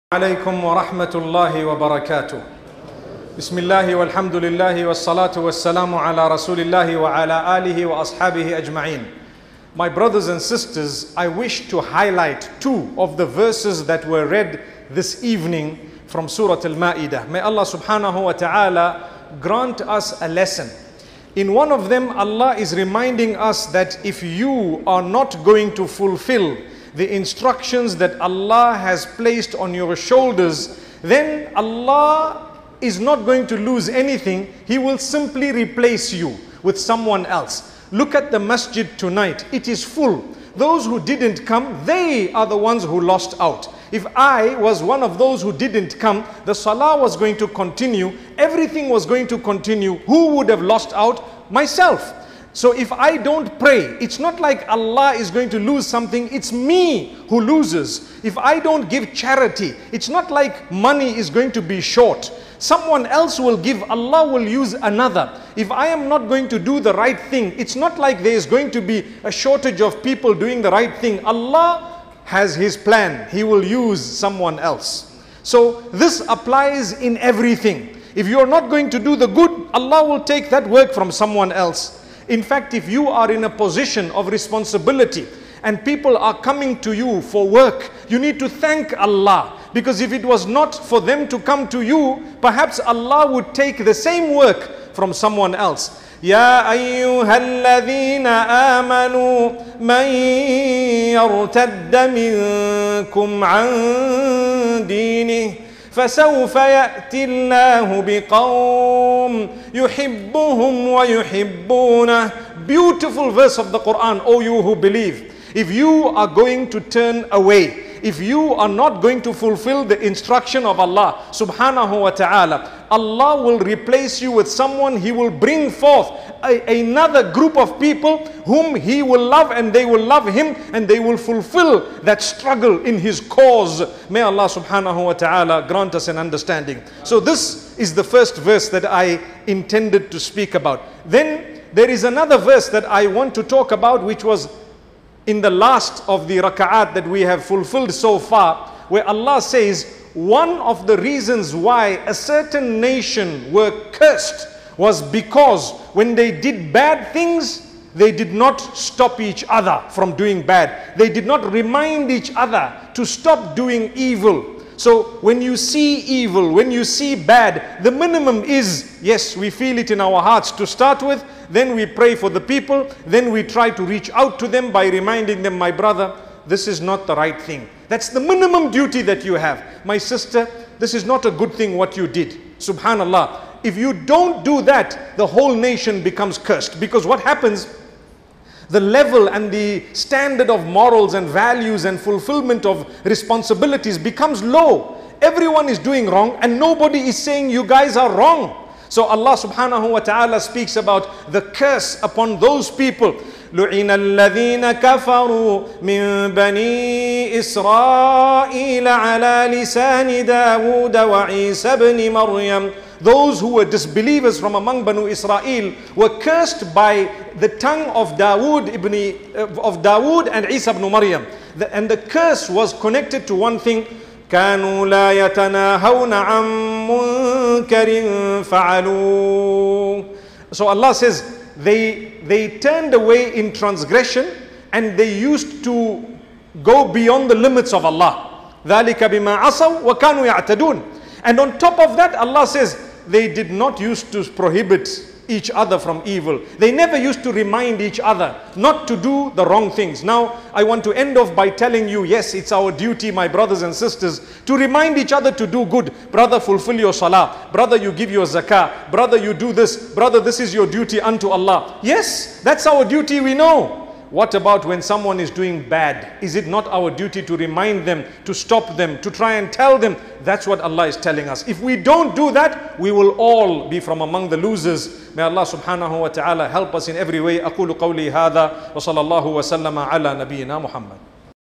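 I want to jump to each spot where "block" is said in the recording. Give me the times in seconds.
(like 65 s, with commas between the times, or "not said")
not said.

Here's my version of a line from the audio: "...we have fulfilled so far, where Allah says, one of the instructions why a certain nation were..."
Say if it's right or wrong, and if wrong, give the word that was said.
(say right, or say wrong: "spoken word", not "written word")
wrong: "reasons", not "instructions".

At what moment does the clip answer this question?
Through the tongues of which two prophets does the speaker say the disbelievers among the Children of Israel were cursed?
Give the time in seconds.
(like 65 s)
219 s.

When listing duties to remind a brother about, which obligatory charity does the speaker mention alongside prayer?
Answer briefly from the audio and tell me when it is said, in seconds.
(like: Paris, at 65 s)
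Zakah, at 258 s.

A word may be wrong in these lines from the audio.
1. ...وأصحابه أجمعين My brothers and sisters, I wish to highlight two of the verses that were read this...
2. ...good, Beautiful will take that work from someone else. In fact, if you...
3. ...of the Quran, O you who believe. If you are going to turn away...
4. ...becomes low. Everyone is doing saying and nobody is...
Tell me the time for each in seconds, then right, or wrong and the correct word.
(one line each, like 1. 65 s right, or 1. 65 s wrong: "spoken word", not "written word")
1. 7 s right
2. 79 s wrong: "Allah", not "Beautiful"
3. 113 s right
4. 193 s wrong: "wrong", not "saying".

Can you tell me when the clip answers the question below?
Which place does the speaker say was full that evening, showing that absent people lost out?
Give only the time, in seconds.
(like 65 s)
38 s.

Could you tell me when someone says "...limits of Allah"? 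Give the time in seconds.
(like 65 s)
237 s.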